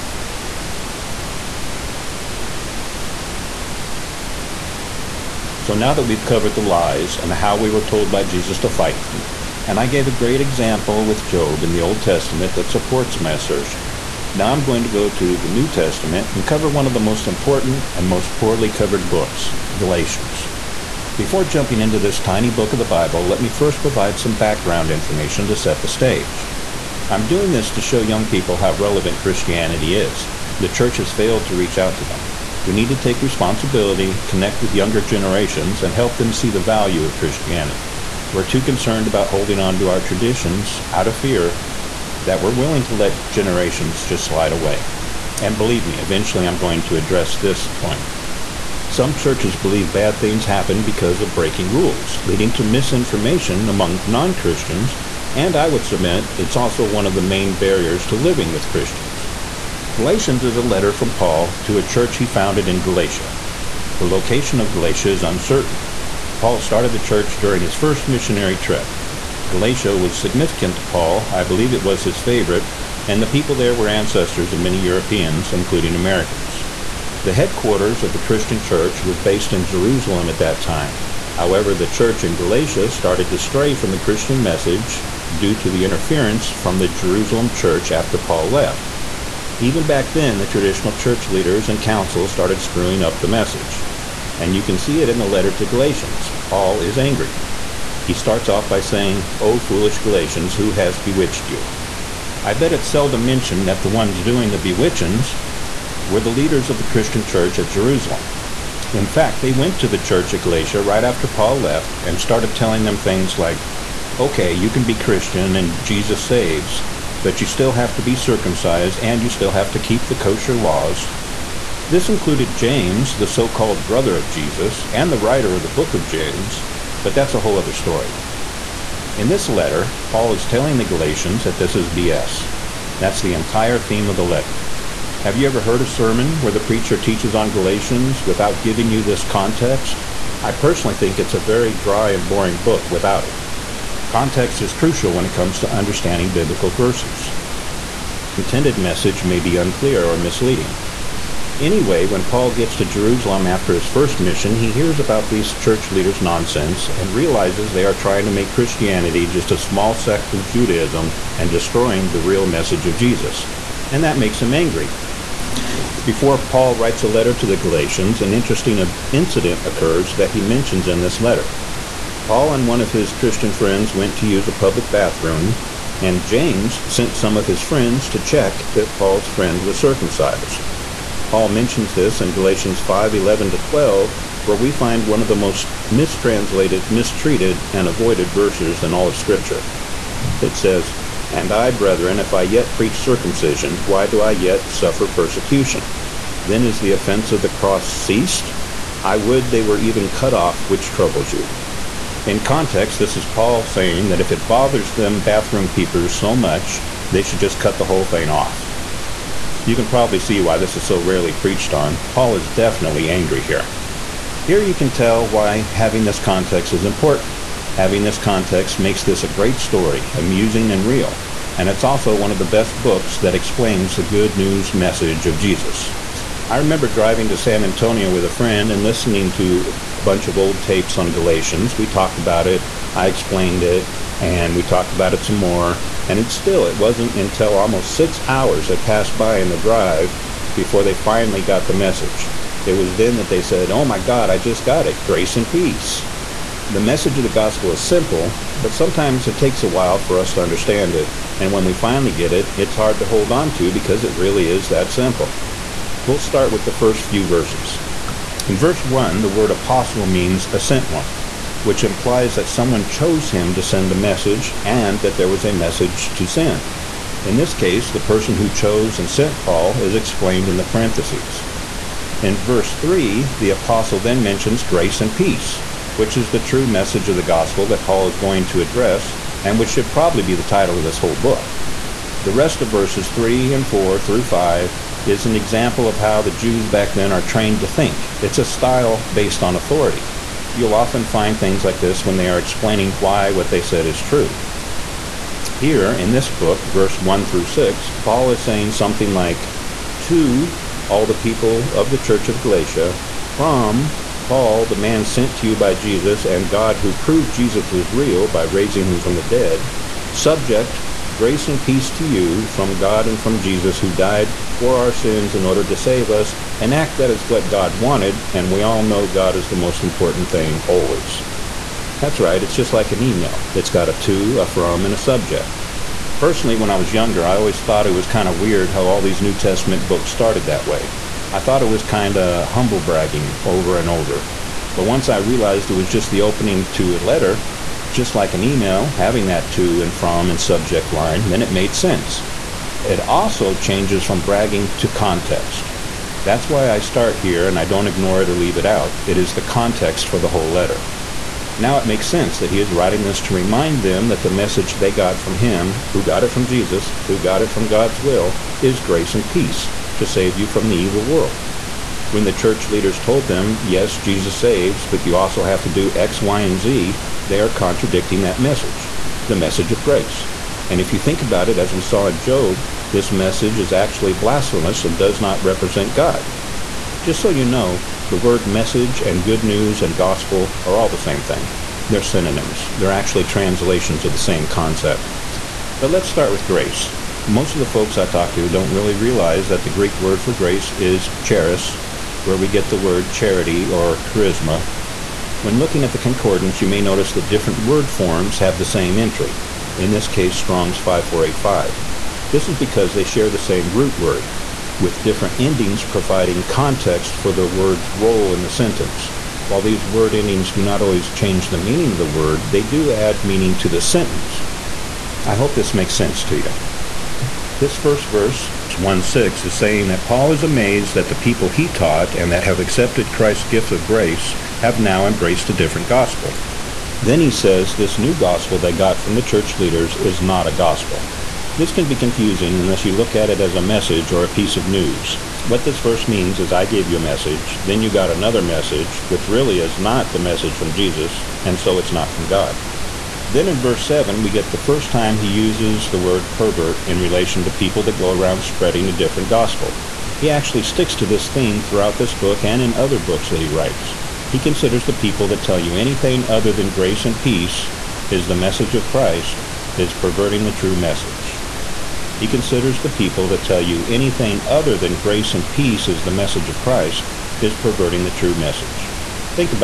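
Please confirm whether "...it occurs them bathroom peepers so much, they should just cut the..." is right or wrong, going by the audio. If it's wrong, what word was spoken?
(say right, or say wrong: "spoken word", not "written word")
wrong: "bothers", not "occurs".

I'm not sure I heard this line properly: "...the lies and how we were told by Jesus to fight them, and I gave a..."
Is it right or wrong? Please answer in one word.
right.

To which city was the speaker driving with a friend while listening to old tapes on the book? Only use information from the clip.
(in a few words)
San Antonio.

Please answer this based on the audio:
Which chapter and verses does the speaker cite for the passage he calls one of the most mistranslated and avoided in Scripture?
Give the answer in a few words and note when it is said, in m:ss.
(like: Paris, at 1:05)
Galatians 5:11-12, at 3:02.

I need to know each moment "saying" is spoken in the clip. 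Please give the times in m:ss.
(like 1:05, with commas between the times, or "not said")
1:38, 3:23, 4:58, 6:59.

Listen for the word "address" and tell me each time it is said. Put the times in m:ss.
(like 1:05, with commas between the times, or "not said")
0:46, 4:38.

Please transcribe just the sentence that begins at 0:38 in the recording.
We're too concerned about holding on to our traditions out of fear that we're willing to let generations just slide away.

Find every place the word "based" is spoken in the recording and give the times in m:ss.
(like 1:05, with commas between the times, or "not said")
1:19, 4:49.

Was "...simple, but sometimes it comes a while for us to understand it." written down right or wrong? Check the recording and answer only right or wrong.
wrong.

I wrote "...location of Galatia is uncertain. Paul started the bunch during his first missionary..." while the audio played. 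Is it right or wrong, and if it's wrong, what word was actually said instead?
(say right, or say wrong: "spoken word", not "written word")
wrong: "church", not "bunch".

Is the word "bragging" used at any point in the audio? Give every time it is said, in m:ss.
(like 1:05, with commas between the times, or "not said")
5:32, 5:44.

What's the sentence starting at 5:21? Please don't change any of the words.
That's right, it's just like an email.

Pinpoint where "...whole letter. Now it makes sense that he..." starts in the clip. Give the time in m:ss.
5:50.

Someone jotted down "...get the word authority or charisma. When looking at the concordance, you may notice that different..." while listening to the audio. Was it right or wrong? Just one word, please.
wrong.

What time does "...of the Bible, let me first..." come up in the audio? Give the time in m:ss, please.
0:22.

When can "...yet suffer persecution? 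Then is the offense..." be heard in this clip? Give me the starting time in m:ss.
3:14.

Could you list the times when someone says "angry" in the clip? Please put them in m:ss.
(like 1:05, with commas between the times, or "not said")
1:36, 2:44, 3:33.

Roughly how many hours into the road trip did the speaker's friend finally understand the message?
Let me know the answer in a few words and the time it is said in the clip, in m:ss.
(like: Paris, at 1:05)
6, at 3:57.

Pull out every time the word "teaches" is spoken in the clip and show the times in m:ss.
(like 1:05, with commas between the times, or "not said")
2:16.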